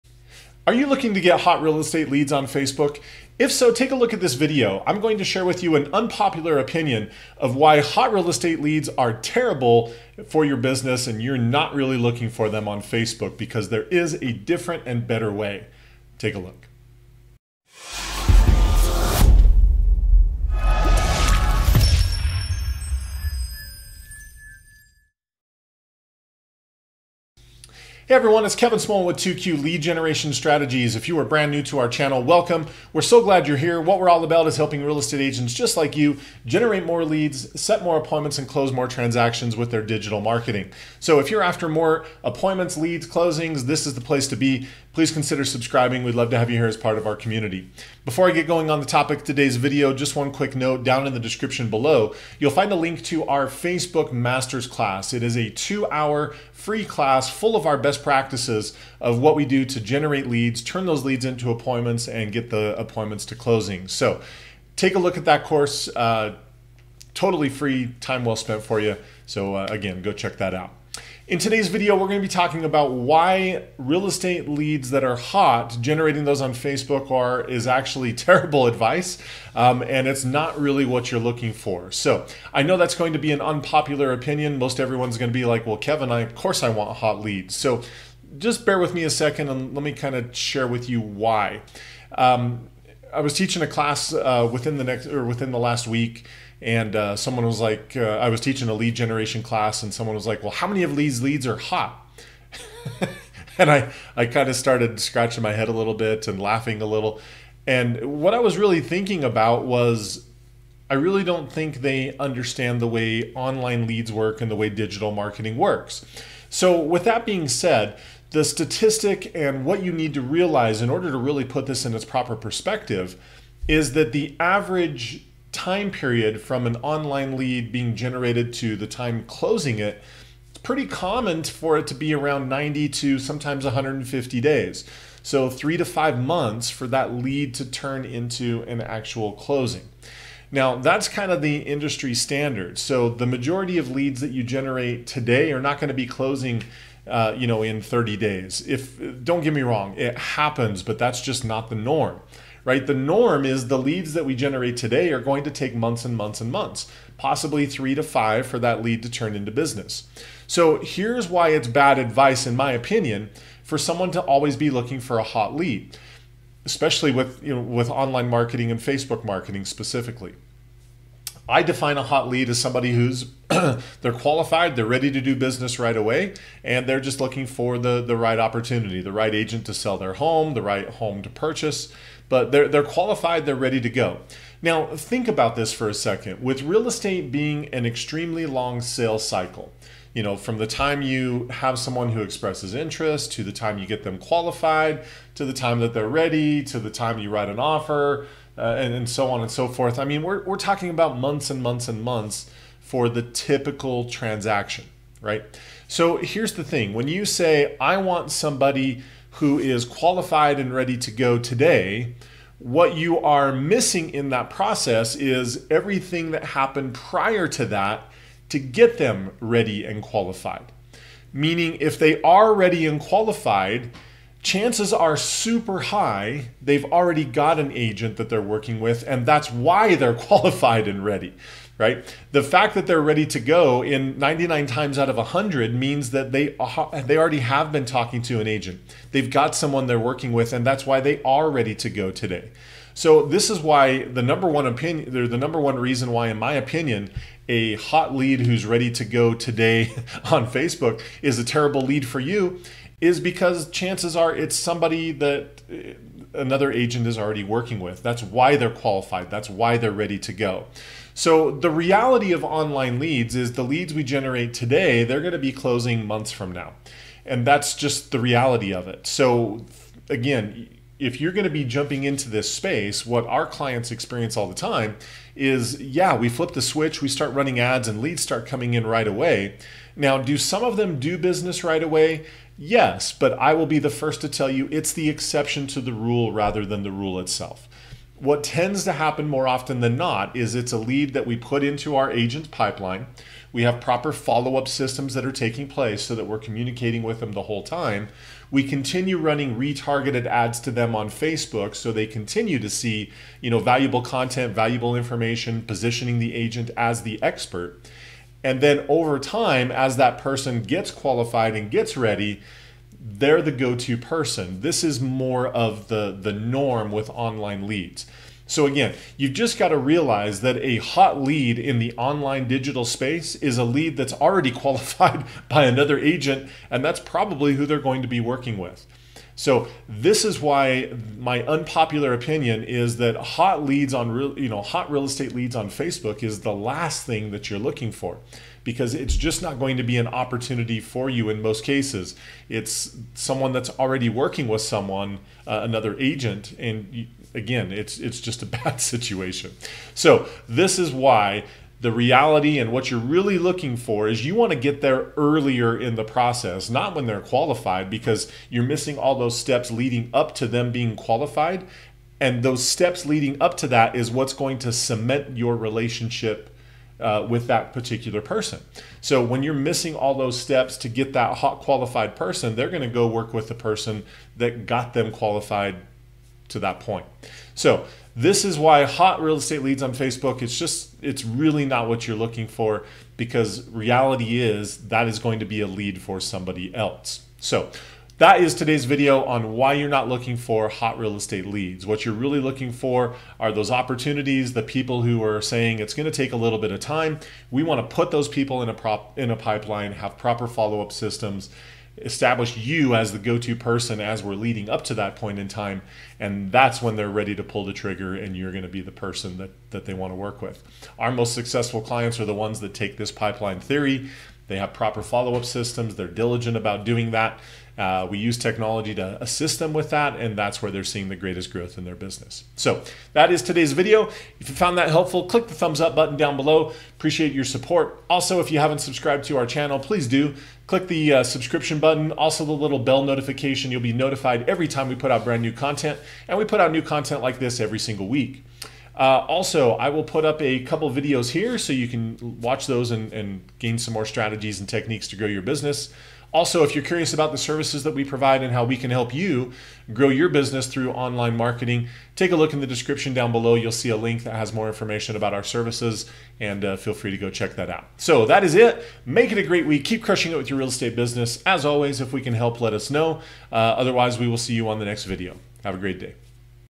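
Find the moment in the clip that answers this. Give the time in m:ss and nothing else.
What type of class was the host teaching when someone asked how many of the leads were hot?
1:38.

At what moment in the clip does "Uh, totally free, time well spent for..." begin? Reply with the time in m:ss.
1:05.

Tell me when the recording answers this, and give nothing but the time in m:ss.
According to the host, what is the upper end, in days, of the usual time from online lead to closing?
2:13.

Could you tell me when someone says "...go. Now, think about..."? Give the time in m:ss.
3:03.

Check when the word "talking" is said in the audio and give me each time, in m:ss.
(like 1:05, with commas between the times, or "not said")
1:12, 3:20, 3:57.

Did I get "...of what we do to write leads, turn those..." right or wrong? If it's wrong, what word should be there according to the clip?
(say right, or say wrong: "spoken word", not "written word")
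wrong: "generate", not "write".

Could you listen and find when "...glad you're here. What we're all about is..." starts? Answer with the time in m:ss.
0:33.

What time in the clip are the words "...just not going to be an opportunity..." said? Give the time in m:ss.
5:39.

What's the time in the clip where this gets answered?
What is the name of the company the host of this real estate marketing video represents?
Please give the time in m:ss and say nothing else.
0:29.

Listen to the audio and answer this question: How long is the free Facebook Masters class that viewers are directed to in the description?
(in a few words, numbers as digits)
2 hours.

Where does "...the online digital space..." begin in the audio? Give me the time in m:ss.
5:21.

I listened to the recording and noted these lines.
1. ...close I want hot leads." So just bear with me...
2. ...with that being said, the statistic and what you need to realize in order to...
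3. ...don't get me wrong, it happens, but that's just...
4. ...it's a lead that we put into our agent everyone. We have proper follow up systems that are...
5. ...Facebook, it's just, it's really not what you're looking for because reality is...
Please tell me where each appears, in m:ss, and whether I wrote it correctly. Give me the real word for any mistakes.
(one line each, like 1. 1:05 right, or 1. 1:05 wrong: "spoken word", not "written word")
1. 1:26 wrong: "course", not "close"
2. 1:56 right
3. 2:29 right
4. 4:50 wrong: "pipeline", not "everyone"
5. 6:19 right.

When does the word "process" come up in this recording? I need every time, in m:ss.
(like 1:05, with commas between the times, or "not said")
3:34, 5:56.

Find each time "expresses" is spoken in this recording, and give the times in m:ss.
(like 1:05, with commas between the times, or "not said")
3:12.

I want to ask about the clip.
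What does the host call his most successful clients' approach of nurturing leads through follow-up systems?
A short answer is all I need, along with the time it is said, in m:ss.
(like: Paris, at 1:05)
pipeline theory, at 6:53.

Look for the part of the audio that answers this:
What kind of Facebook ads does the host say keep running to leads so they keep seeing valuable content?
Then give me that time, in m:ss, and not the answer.
4:59.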